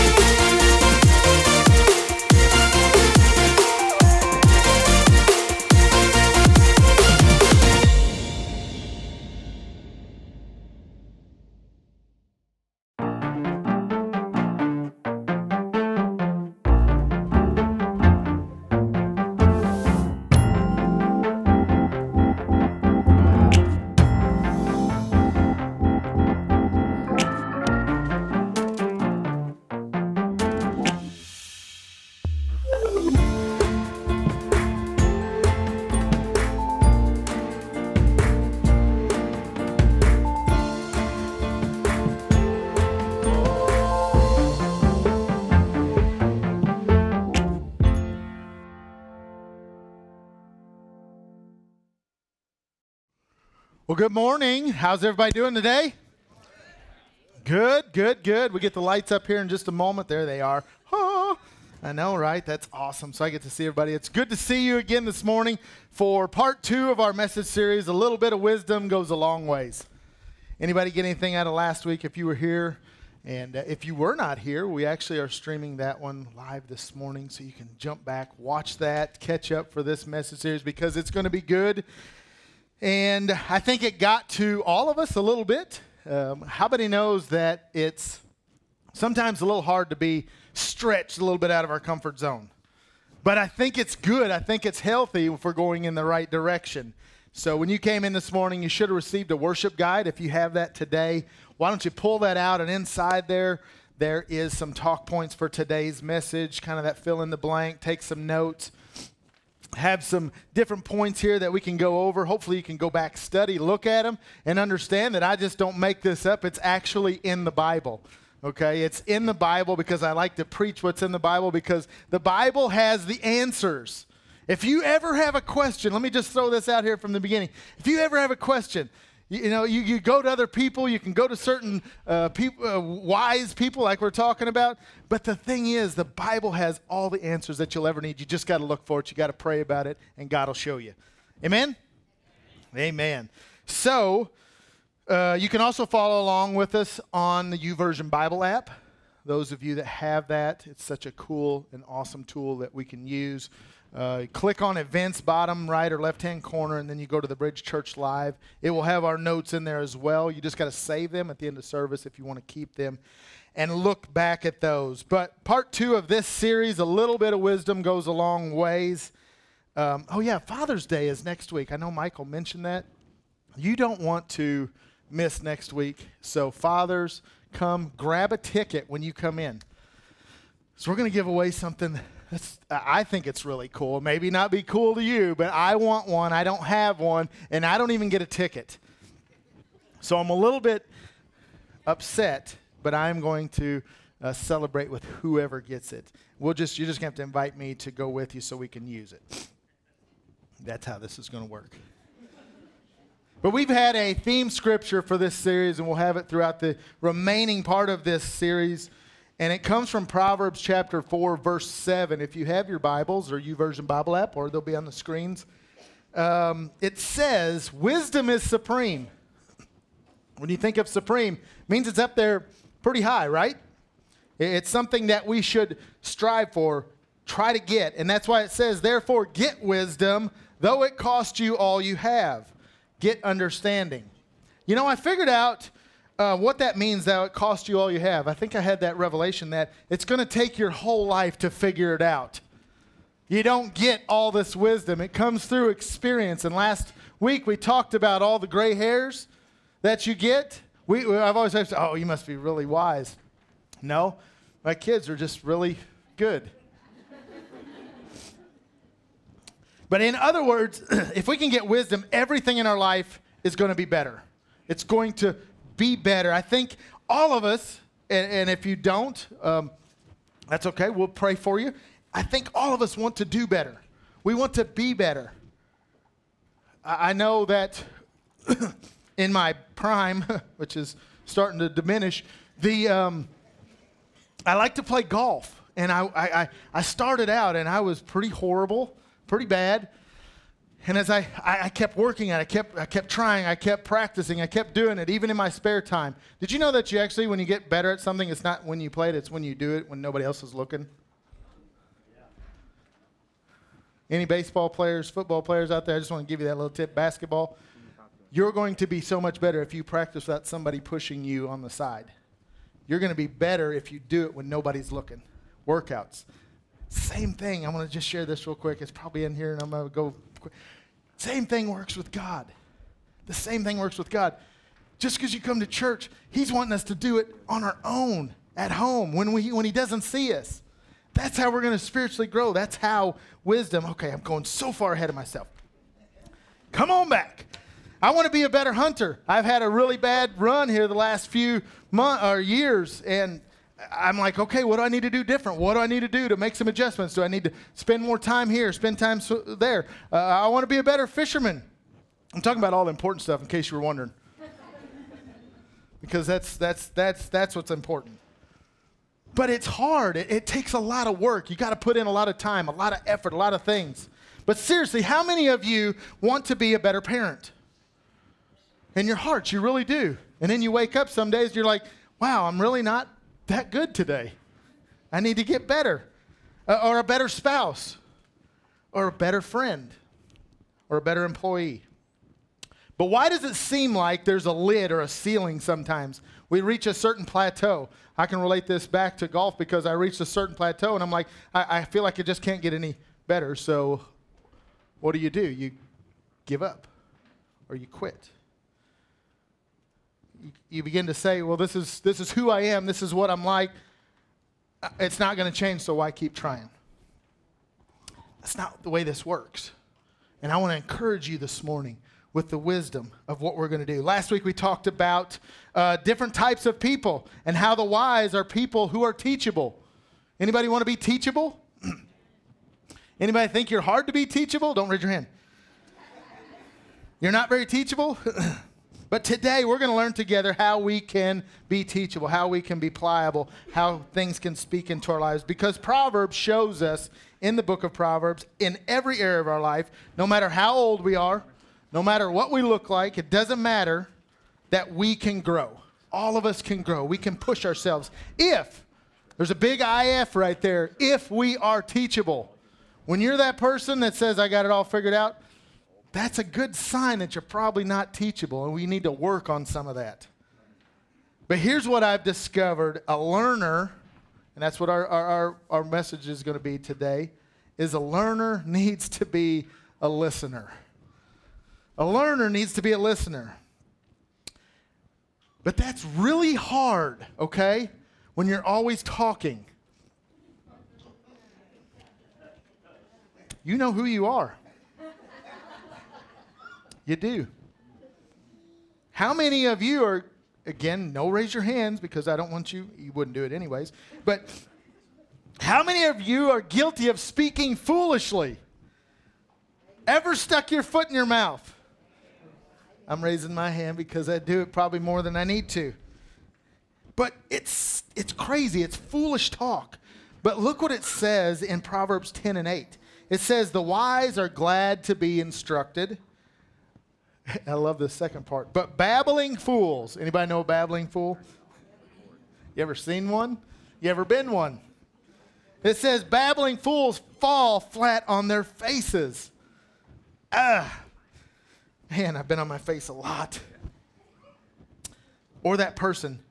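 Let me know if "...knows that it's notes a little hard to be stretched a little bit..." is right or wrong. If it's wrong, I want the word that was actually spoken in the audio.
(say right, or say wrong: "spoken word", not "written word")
wrong: "sometimes", not "notes".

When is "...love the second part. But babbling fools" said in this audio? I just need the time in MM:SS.
08:37.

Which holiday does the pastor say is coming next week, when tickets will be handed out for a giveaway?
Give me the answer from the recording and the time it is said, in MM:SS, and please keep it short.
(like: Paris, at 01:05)
Father's Day, at 02:50.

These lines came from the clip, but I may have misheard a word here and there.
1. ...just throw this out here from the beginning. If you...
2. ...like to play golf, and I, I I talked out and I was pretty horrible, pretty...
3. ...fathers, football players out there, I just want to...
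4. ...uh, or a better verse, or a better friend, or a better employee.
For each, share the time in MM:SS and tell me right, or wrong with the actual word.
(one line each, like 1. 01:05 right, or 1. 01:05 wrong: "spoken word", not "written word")
1. 02:06 right
2. 04:44 wrong: "started", not "talked"
3. 05:04 wrong: "players", not "fathers"
4. 06:16 wrong: "spouse", not "verse".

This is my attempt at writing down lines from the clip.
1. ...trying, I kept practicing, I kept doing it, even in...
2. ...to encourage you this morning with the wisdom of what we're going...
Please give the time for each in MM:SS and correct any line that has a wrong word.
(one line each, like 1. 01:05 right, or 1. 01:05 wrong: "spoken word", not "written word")
1. 04:53 right
2. 06:50 right.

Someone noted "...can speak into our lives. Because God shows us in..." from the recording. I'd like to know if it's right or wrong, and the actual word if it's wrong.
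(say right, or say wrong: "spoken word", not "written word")
wrong: "Proverbs", not "God".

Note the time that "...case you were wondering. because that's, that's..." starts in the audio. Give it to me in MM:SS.
05:53.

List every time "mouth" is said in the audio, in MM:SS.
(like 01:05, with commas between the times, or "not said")
08:21.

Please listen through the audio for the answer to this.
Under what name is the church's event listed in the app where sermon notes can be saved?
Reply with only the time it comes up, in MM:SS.
02:37.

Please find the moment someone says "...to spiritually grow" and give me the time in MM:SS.
05:31.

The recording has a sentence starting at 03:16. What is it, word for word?
We'll just you're just gonna have to invite me to go with you so we can use it.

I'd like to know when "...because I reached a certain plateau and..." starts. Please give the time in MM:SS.
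06:29.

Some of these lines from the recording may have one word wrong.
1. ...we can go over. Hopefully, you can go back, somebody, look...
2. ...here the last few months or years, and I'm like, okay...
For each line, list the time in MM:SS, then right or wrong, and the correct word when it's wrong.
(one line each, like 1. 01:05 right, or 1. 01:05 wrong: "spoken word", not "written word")
1. 01:51 wrong: "study", not "somebody"
2. 05:40 right.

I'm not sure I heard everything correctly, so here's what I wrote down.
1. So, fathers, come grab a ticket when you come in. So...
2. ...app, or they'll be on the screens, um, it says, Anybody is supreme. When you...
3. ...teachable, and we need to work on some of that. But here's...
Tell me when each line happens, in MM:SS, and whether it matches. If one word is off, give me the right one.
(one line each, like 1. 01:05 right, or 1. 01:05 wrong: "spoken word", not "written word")
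1. 02:56 right
2. 03:34 wrong: "Wisdom", not "Anybody"
3. 07:38 right.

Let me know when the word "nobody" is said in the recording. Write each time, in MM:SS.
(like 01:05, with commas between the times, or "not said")
05:00, 05:14.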